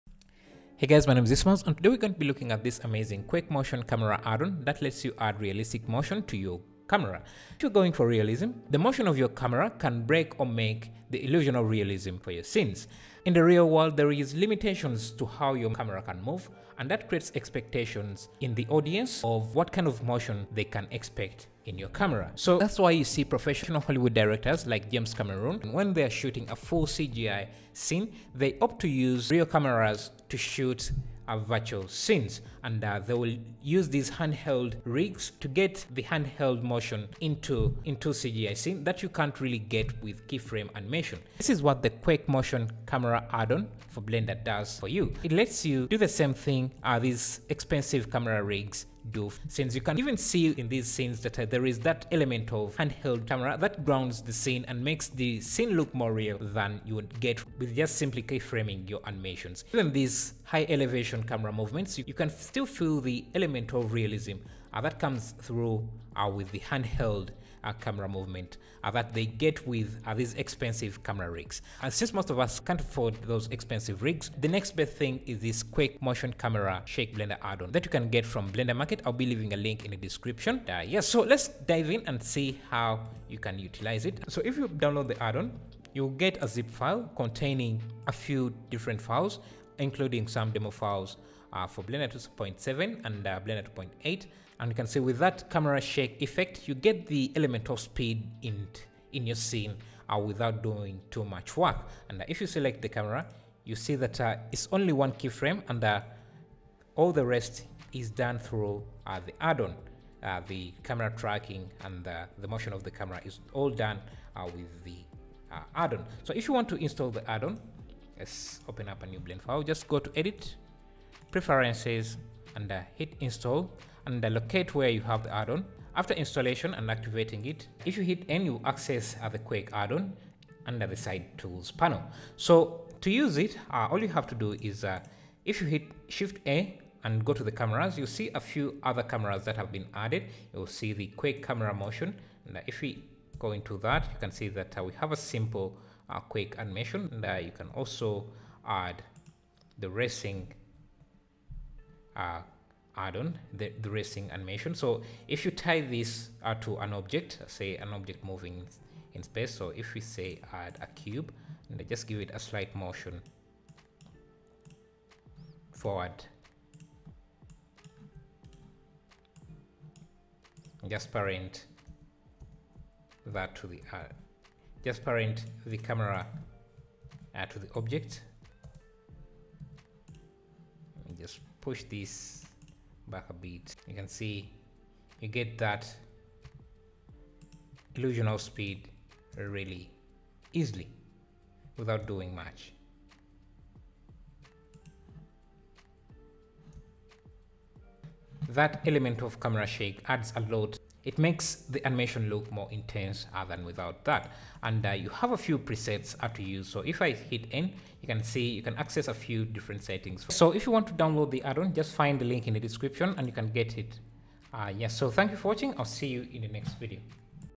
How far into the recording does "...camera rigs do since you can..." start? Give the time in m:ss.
0:48.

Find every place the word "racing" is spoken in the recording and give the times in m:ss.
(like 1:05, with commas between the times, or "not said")
2:29, 2:33.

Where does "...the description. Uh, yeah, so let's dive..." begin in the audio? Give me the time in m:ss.
1:19.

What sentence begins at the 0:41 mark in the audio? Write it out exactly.
This is what the Quake Motion Camera add-on for Blender does for you.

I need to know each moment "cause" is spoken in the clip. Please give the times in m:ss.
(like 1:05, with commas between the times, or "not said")
not said.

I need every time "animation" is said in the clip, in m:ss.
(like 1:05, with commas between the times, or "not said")
0:40, 0:59, 2:26, 2:34, 3:21.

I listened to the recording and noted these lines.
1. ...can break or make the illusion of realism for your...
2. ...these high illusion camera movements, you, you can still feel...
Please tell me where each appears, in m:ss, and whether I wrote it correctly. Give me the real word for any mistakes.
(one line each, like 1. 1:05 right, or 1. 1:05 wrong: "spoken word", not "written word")
1. 0:09 right
2. 0:59 wrong: "elevation", not "illusion".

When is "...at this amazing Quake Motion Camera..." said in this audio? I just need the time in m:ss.
0:02.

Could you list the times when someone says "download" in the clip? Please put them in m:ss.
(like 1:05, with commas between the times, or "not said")
1:24, 3:30.